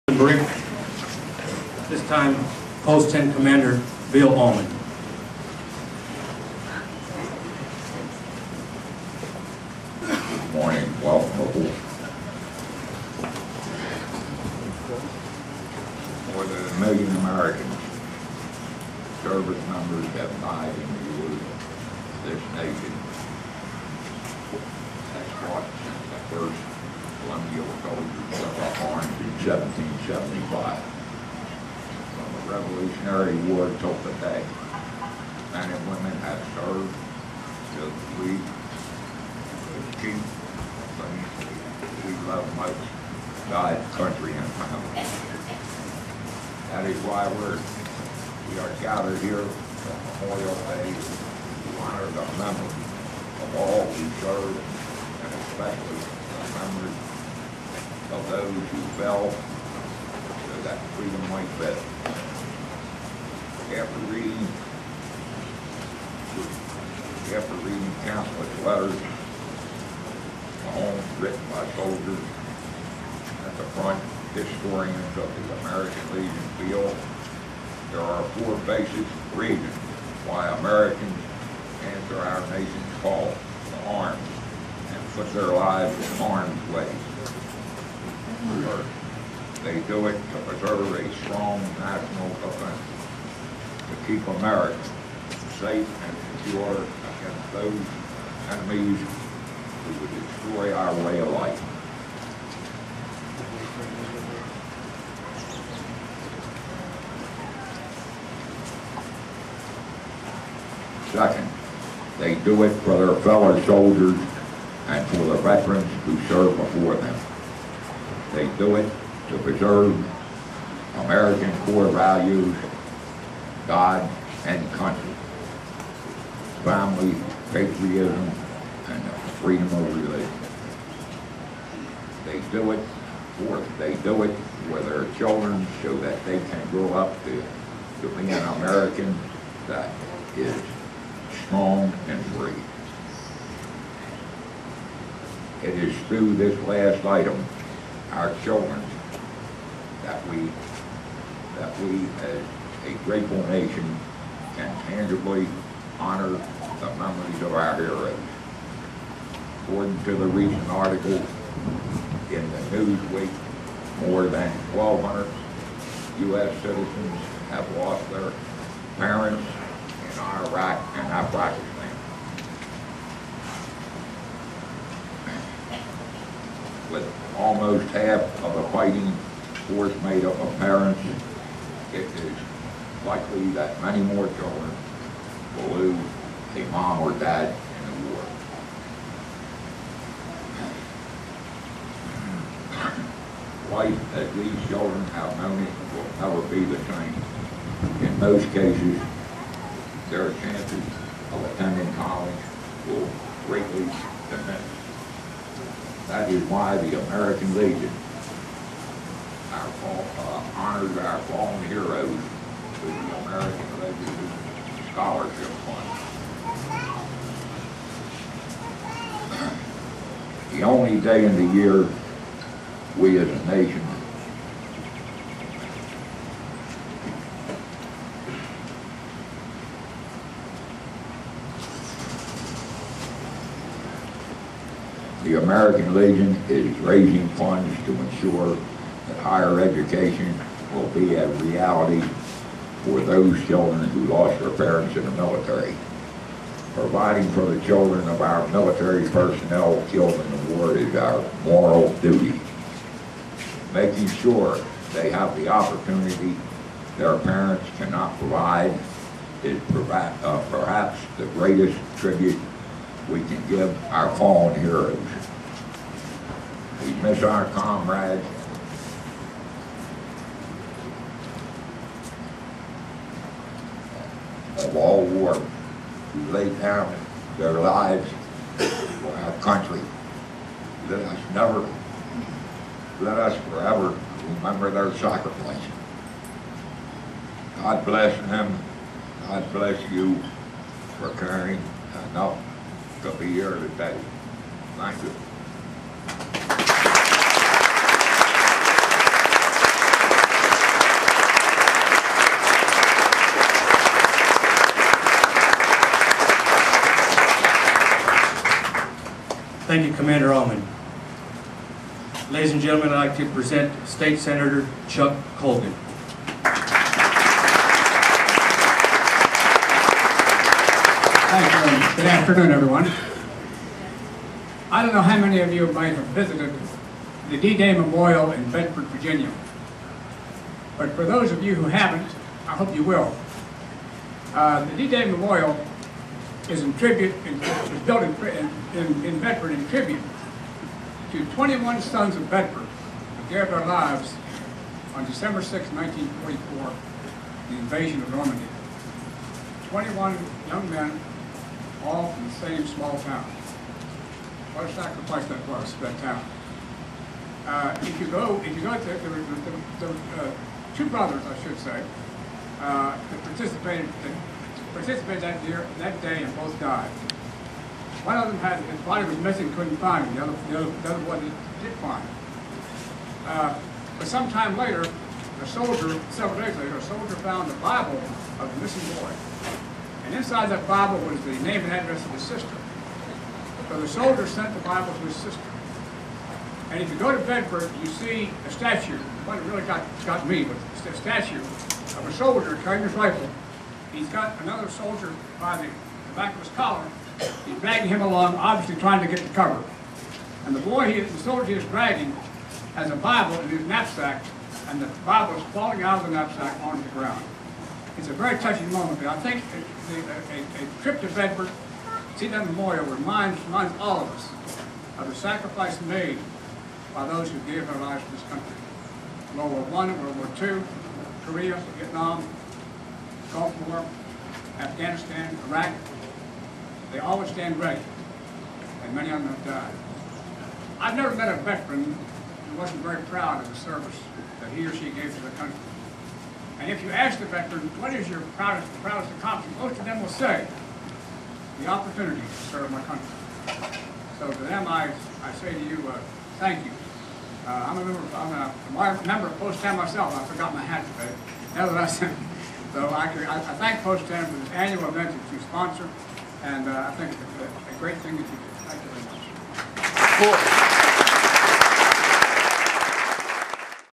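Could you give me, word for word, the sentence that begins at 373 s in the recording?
Uh, but sometime later, a soldier, several days later, a soldier found the Bible of the missing boy.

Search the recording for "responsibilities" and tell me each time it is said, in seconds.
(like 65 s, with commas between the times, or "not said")
not said.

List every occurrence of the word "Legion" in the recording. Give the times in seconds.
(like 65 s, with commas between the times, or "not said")
76 s, 207 s, 213 s, 235 s.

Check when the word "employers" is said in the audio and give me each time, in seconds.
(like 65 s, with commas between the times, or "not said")
not said.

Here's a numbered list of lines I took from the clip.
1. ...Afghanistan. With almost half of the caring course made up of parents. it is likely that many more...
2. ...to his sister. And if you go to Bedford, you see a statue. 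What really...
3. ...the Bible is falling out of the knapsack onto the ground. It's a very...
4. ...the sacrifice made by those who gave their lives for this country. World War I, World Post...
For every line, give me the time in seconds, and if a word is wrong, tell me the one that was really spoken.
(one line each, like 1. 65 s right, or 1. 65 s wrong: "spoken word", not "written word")
1. 171 s wrong: "fighting", not "caring"
2. 384 s right
3. 404 s right
4. 415 s wrong: "War", not "Post".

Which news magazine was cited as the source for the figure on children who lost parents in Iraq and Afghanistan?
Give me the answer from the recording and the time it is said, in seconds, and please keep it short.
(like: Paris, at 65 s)
Newsweek, at 162 s.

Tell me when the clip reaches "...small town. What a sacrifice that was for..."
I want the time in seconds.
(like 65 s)
352 s.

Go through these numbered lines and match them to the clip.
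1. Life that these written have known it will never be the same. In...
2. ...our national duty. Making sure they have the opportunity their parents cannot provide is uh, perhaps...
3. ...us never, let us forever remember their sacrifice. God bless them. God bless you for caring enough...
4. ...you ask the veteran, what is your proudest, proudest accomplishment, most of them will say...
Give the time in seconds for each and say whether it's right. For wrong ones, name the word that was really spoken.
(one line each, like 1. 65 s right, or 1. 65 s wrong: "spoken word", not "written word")
1. 193 s wrong: "children", not "written"
2. 250 s wrong: "moral", not "national"
3. 281 s right
4. 436 s right.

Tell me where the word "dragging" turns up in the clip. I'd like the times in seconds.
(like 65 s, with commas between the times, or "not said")
397 s, 401 s.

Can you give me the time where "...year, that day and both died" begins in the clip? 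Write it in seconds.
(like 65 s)
365 s.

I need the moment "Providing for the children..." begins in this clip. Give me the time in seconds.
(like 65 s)
246 s.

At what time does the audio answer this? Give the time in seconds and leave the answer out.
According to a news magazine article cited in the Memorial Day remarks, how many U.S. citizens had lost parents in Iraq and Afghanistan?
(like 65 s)
164 s.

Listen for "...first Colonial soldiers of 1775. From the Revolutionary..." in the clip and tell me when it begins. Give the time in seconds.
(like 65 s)
26 s.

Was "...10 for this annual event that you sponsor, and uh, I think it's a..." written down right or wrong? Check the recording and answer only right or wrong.
right.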